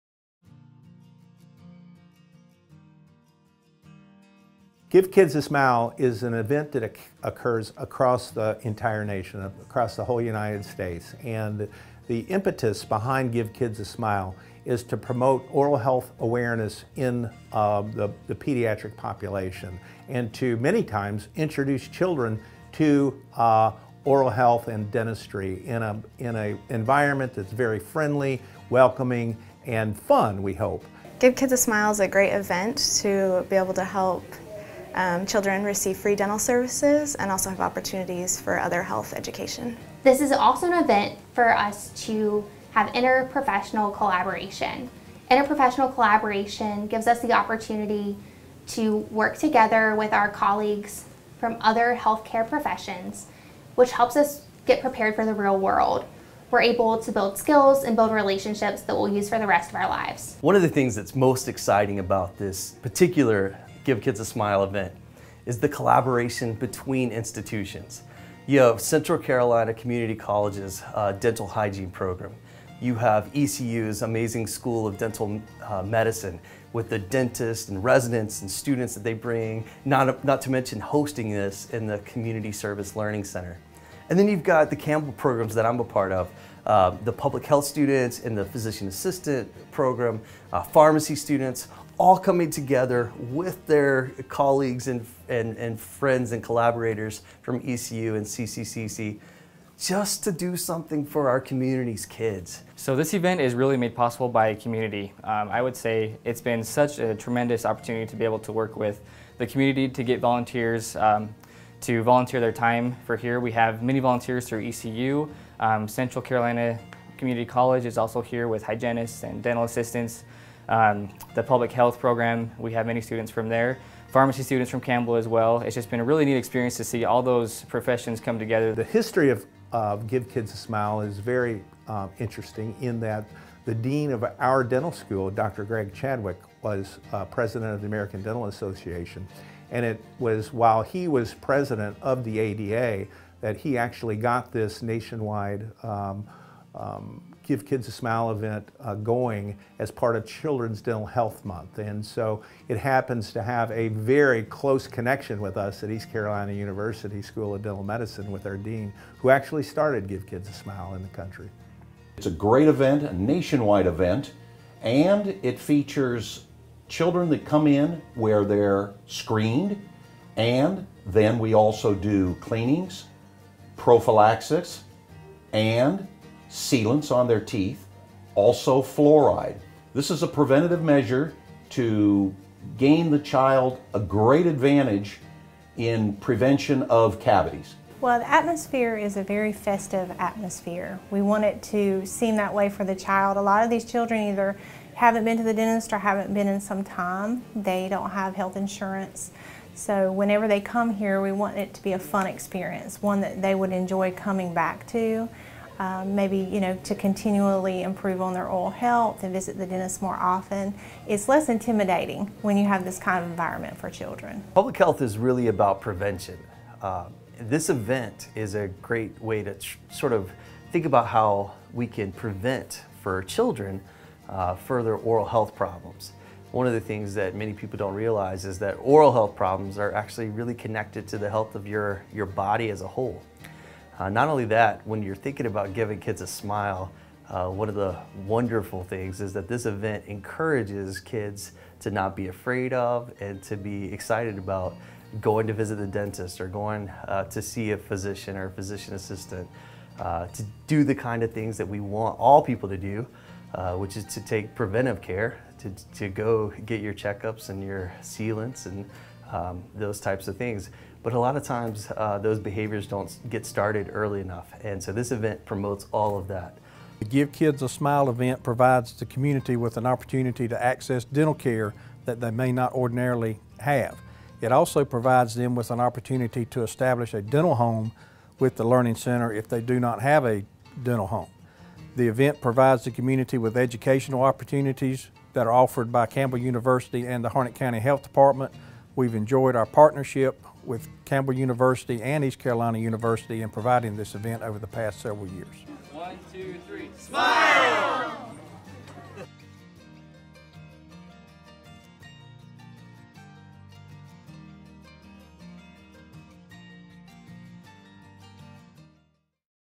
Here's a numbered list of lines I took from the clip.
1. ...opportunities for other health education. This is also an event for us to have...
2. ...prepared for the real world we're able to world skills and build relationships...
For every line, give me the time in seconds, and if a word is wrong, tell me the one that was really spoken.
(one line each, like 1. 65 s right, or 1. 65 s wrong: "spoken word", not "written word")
1. 37 s right
2. 54 s wrong: "build", not "world".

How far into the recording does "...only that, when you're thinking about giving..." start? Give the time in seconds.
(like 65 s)
234 s.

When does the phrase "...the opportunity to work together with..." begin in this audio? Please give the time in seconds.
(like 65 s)
47 s.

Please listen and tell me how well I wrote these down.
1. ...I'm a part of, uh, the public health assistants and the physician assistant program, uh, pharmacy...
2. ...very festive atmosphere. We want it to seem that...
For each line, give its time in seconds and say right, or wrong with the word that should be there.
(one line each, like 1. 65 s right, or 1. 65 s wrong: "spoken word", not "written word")
1. 85 s wrong: "students", not "assistants"
2. 189 s right.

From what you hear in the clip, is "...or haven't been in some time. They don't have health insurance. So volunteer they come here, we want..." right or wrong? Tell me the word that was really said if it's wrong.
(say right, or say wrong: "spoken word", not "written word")
wrong: "whenever", not "volunteer".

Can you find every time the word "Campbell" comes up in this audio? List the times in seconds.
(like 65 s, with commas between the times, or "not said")
84 s, 124 s, 286 s, 291 s.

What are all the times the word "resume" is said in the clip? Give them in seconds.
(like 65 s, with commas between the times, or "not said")
not said.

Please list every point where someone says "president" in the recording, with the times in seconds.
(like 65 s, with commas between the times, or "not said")
137 s, 141 s.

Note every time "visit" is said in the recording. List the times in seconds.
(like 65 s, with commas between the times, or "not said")
209 s, 245 s.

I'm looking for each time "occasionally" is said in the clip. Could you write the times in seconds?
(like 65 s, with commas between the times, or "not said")
not said.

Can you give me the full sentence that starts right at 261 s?
But a lot of times uh, those behaviors don't get started early enough.